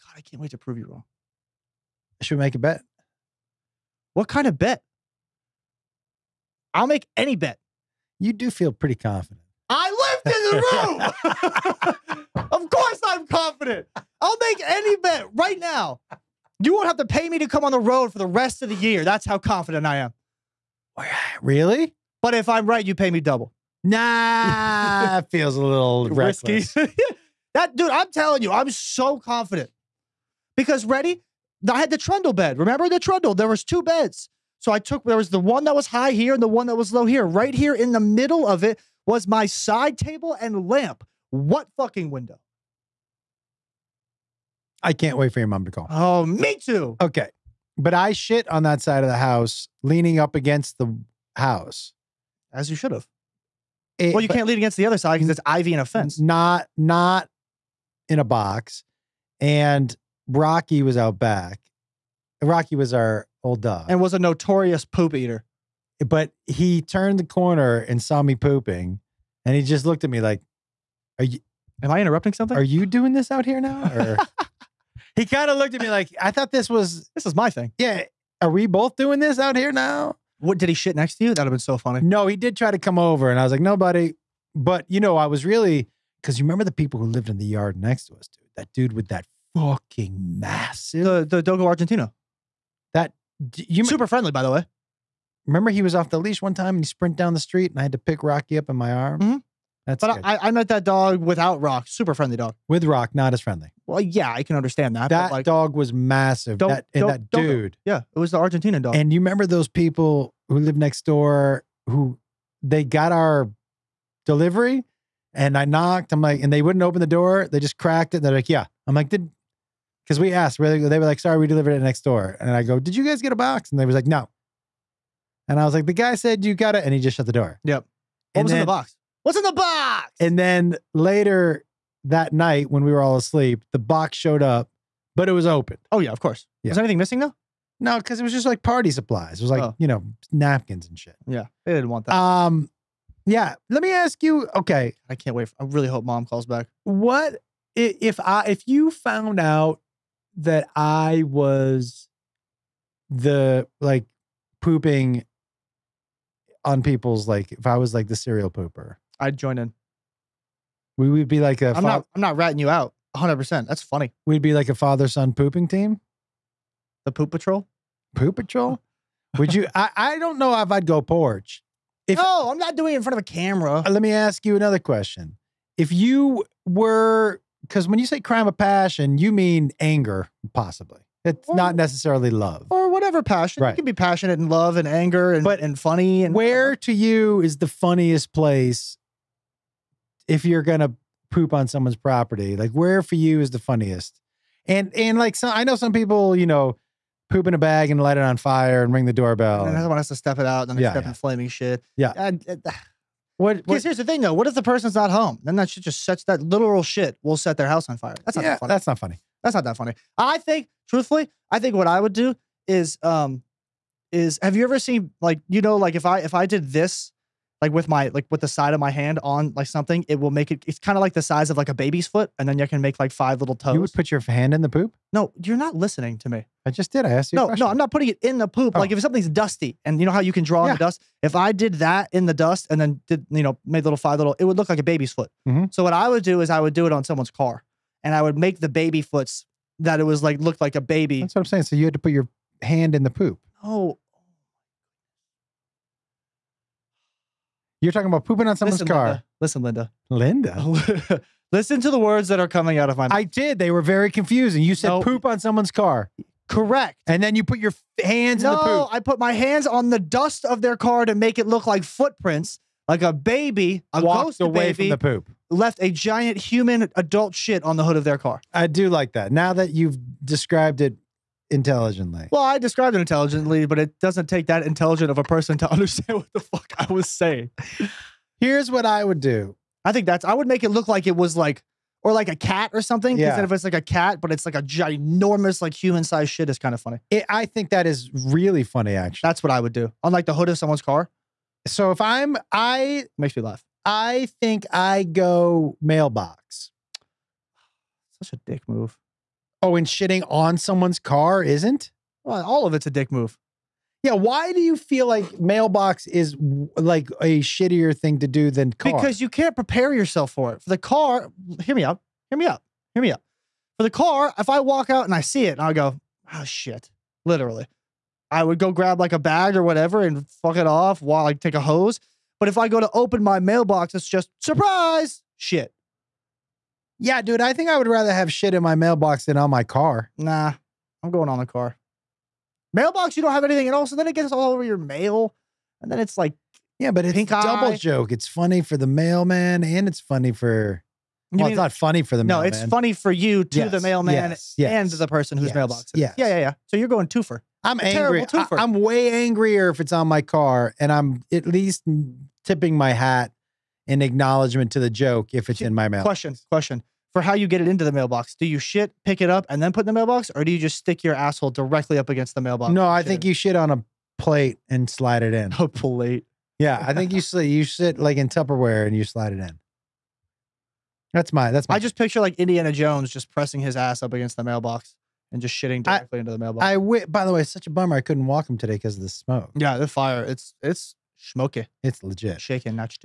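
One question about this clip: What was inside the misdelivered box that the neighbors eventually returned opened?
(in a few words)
Party supplies.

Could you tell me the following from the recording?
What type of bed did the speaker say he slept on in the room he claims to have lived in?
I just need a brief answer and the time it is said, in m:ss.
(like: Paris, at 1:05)
Trundle bed, at 0:31.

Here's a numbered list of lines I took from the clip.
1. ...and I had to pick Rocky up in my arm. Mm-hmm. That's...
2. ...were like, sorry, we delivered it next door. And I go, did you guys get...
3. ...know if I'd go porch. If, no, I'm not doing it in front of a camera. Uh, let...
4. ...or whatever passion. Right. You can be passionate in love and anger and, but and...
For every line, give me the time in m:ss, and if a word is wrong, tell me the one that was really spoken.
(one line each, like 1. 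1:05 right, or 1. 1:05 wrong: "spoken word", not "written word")
1. 1:37 right
2. 2:00 right
3. 2:50 right
4. 3:02 right.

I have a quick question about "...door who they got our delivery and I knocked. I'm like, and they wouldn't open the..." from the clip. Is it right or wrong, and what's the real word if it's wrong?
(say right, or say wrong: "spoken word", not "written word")
right.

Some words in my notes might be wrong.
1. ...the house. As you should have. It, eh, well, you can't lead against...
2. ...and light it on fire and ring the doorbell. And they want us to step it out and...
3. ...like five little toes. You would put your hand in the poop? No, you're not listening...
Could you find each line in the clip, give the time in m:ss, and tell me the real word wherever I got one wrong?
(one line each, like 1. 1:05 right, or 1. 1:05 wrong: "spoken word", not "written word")
1. 0:50 right
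2. 3:17 right
3. 3:42 right.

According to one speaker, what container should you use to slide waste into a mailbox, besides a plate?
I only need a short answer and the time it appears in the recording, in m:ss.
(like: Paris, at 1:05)
Tupperware, at 6:08.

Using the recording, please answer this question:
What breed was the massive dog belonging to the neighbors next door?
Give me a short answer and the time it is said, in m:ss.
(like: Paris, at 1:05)
Dogo Argentino, at 1:31.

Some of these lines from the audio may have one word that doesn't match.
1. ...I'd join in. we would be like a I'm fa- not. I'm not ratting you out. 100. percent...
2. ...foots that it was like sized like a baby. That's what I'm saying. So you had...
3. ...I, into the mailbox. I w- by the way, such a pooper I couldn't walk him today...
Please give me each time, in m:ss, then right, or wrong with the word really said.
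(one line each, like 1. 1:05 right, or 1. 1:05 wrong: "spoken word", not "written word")
1. 2:39 right
2. 3:59 wrong: "looked", not "sized"
3. 6:16 wrong: "bummer", not "pooper".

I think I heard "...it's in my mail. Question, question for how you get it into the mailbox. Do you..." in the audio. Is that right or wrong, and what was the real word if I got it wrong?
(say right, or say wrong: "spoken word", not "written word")
right.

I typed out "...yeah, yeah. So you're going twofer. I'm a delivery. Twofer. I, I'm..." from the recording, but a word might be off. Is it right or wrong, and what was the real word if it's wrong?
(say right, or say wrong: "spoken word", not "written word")
wrong: "angry", not "delivery".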